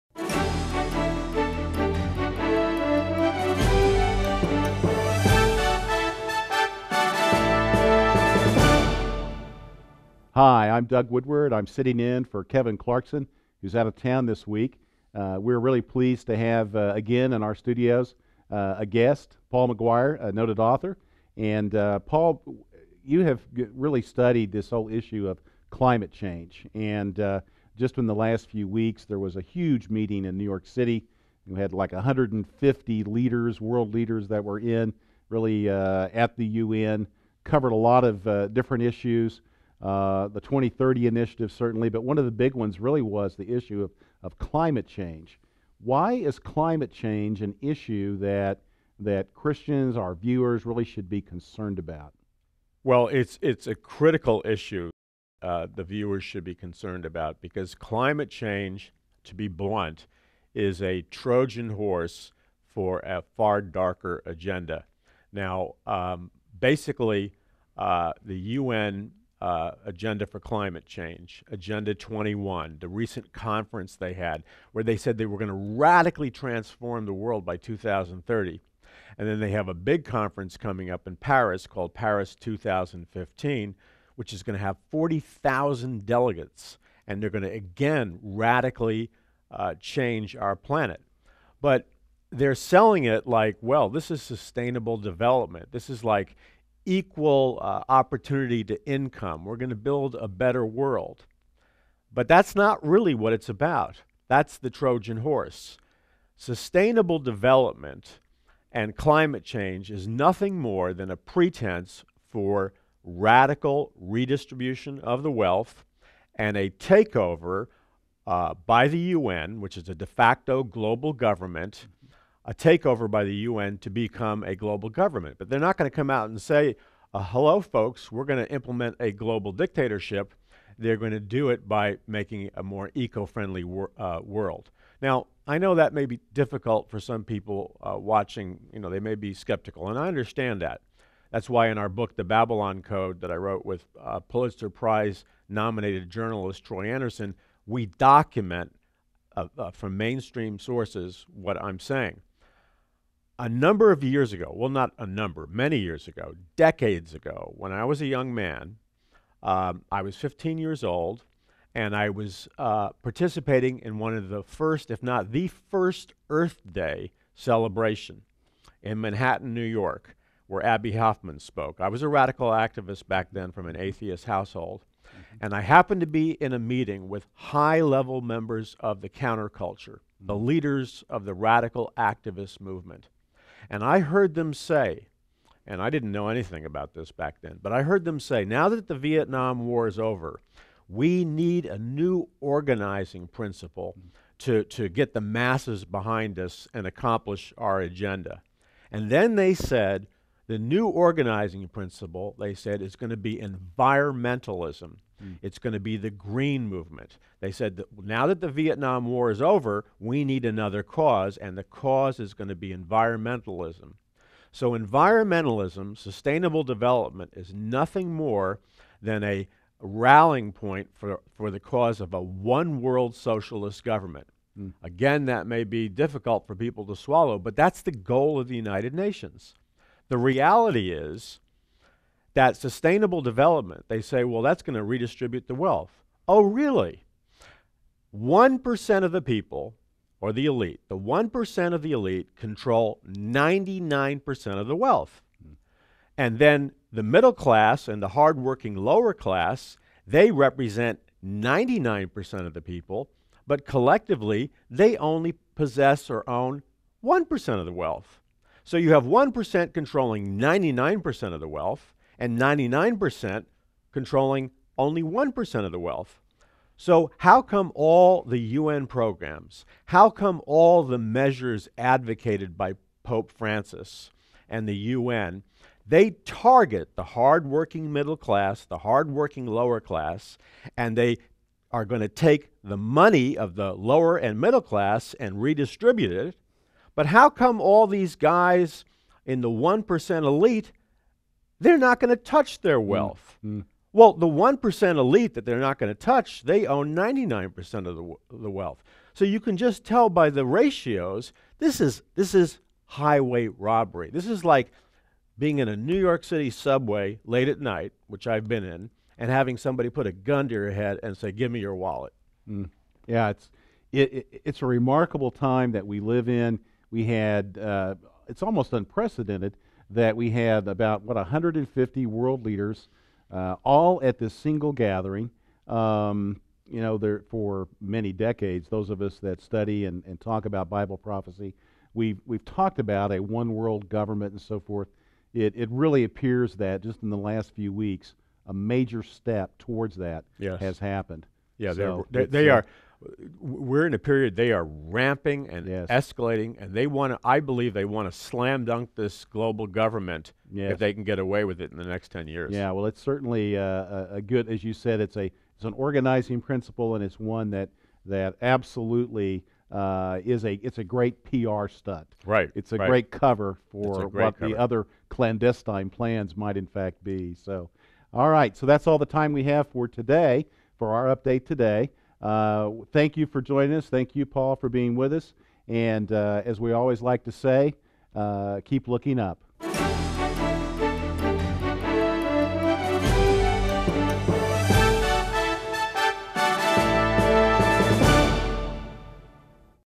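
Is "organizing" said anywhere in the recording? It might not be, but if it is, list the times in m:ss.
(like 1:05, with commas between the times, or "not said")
3:12, 3:20, 5:55.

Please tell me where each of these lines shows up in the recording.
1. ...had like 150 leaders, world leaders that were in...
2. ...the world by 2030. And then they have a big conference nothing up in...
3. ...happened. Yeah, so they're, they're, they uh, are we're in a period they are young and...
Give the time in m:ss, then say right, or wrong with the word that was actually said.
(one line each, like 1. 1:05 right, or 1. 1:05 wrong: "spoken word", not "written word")
1. 0:31 right
2. 1:17 wrong: "coming", not "nothing"
3. 5:40 wrong: "ramping", not "young".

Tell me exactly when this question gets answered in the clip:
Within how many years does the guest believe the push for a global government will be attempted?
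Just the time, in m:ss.
5:52.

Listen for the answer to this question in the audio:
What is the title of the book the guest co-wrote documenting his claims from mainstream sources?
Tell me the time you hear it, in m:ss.
2:22.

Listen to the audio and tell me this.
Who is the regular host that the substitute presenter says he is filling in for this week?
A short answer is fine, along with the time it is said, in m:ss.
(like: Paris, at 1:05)
Kevin Clarkson, at 0:12.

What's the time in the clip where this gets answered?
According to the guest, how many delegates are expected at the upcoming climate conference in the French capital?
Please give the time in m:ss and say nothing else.
1:24.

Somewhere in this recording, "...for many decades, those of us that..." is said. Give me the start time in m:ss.
5:27.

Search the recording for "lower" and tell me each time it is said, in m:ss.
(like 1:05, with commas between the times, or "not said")
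4:08, 4:39, 4:43.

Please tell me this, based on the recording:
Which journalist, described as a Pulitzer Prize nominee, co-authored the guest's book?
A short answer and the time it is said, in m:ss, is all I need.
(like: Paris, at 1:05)
Troy Anderson, at 2:26.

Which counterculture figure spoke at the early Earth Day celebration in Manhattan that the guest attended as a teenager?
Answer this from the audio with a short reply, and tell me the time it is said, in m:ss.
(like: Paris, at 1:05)
Abbie Hoffman, at 2:50.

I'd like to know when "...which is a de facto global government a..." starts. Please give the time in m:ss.
1:59.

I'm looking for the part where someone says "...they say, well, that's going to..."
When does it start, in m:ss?
3:53.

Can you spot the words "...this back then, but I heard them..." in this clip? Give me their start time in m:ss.
3:06.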